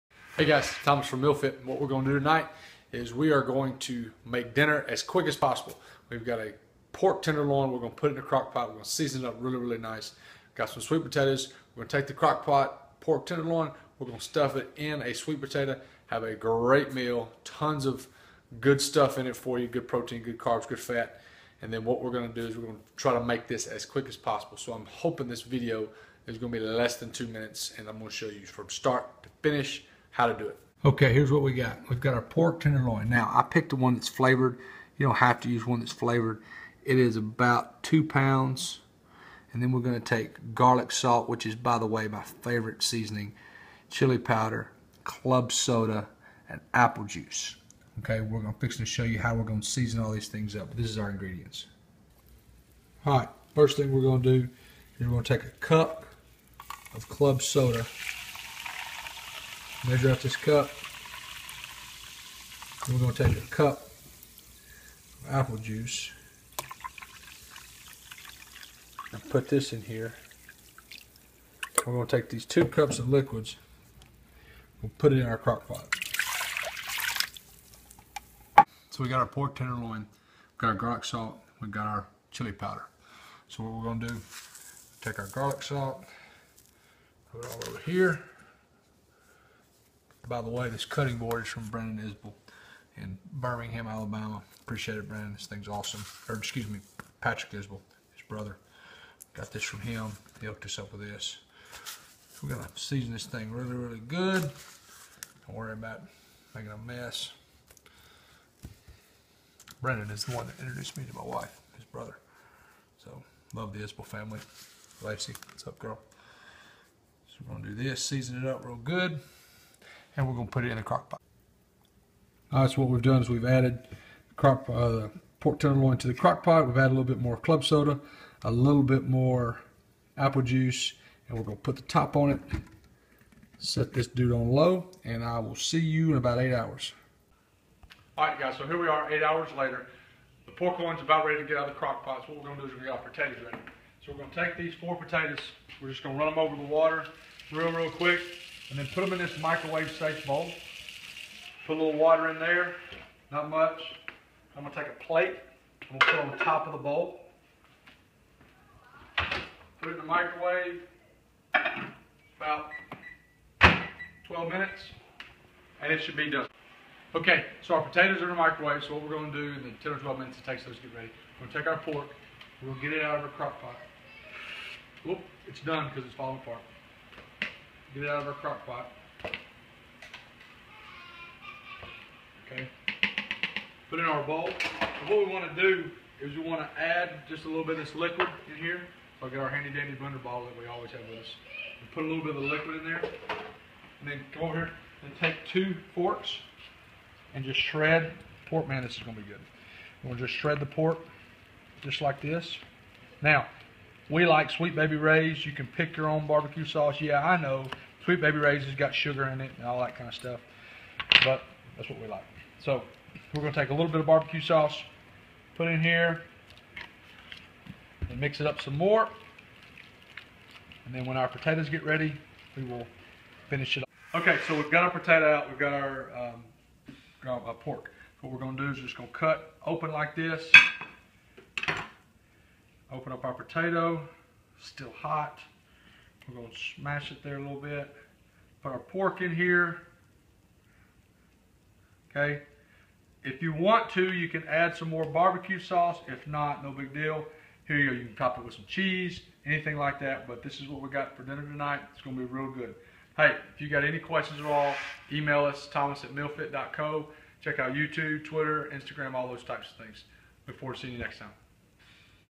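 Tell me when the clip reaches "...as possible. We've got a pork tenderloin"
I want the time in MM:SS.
00:05.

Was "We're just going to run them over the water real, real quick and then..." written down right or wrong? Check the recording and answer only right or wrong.
right.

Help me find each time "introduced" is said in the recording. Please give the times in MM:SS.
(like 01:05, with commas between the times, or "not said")
01:50.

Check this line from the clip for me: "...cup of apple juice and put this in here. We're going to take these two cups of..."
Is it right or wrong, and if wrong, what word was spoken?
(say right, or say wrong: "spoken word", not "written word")
right.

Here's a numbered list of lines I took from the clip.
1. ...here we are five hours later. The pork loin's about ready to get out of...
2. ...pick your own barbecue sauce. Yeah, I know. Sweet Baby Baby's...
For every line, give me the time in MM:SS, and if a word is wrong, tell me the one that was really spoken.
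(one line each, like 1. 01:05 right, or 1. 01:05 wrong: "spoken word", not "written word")
1. 02:18 wrong: "eight", not "five"
2. 03:25 wrong: "Ray", not "Baby".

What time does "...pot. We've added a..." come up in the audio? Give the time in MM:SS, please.
02:06.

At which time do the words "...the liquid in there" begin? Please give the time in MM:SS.
03:12.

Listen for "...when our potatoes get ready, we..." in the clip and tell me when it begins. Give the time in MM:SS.
03:41.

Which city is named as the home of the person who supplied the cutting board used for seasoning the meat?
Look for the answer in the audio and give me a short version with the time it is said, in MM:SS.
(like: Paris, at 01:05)
Birmingham, Alabama, at 01:33.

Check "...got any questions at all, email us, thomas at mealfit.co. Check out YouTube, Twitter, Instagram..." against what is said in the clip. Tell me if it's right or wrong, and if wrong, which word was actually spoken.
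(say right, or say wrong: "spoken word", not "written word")
right.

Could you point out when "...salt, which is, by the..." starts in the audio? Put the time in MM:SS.
00:40.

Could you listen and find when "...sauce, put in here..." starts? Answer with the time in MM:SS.
03:34.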